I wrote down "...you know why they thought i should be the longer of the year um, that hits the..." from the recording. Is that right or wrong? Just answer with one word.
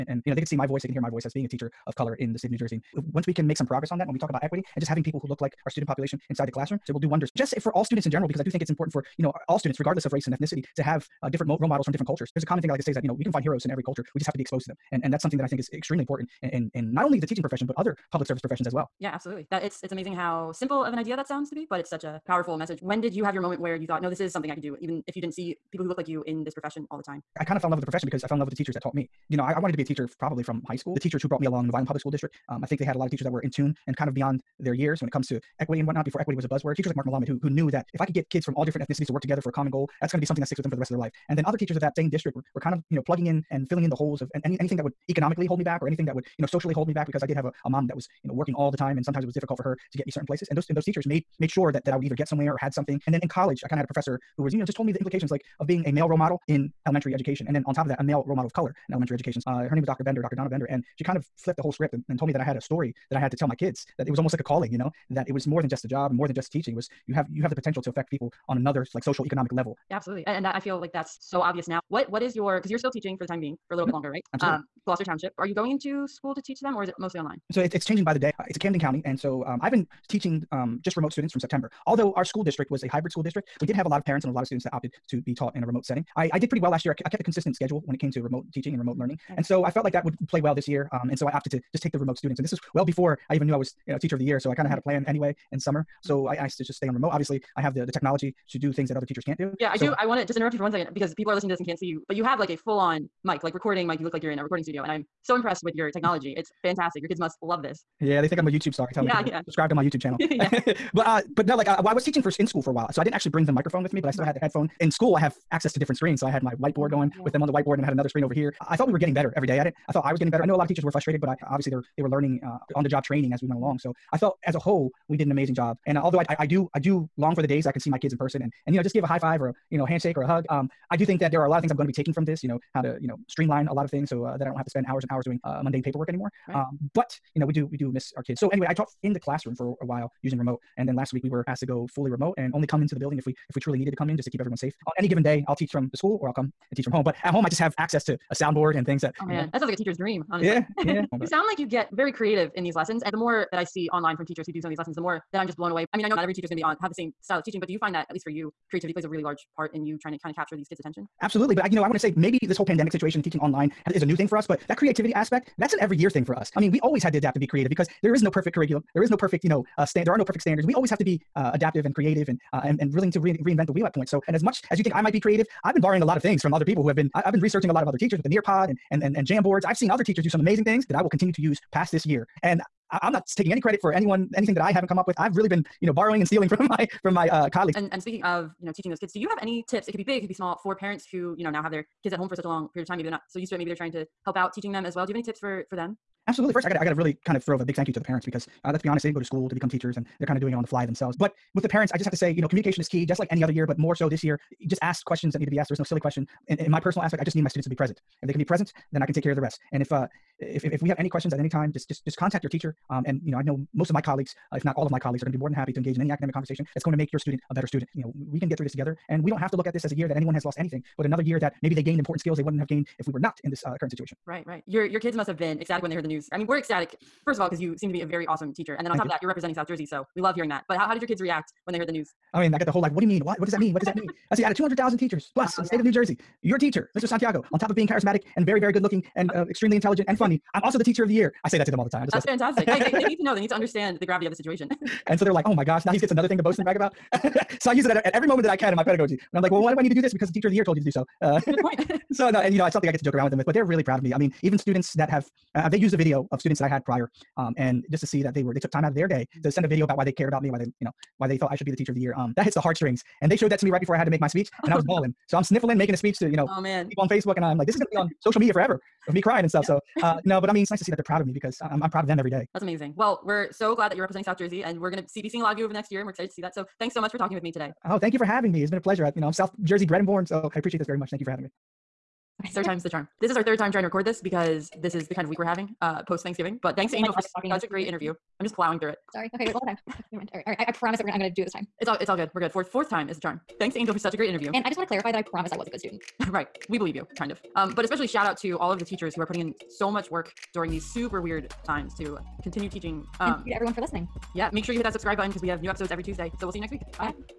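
wrong.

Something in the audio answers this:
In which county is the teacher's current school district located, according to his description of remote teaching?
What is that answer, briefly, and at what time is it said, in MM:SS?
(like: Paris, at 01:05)
Camden County, at 01:18.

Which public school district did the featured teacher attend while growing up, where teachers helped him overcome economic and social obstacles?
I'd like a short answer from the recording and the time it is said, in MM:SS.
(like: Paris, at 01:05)
Vineland, at 00:31.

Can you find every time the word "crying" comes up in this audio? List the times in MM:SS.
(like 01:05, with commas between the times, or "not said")
04:29.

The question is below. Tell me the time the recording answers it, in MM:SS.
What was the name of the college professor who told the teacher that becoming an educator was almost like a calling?
01:00.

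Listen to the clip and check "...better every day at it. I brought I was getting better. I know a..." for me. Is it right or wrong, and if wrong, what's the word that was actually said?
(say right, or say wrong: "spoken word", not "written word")
wrong: "thought", not "brought".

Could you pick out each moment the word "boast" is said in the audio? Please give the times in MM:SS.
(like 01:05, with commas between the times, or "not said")
04:06.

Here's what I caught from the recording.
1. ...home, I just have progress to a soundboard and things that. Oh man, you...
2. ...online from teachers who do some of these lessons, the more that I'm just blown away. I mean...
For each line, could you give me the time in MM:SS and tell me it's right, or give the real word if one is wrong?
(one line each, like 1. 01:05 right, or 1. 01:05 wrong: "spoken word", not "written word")
1. 02:27 wrong: "access", not "progress"
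2. 02:33 right.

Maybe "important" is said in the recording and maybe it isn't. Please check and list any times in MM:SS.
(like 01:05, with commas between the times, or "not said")
00:08, 00:16, 03:41.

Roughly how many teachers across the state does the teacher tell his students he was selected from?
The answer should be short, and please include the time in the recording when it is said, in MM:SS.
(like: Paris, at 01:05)
200,000, at 03:54.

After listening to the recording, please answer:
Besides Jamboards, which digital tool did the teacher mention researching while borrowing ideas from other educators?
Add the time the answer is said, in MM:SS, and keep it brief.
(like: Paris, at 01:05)
Nearpod, at 02:58.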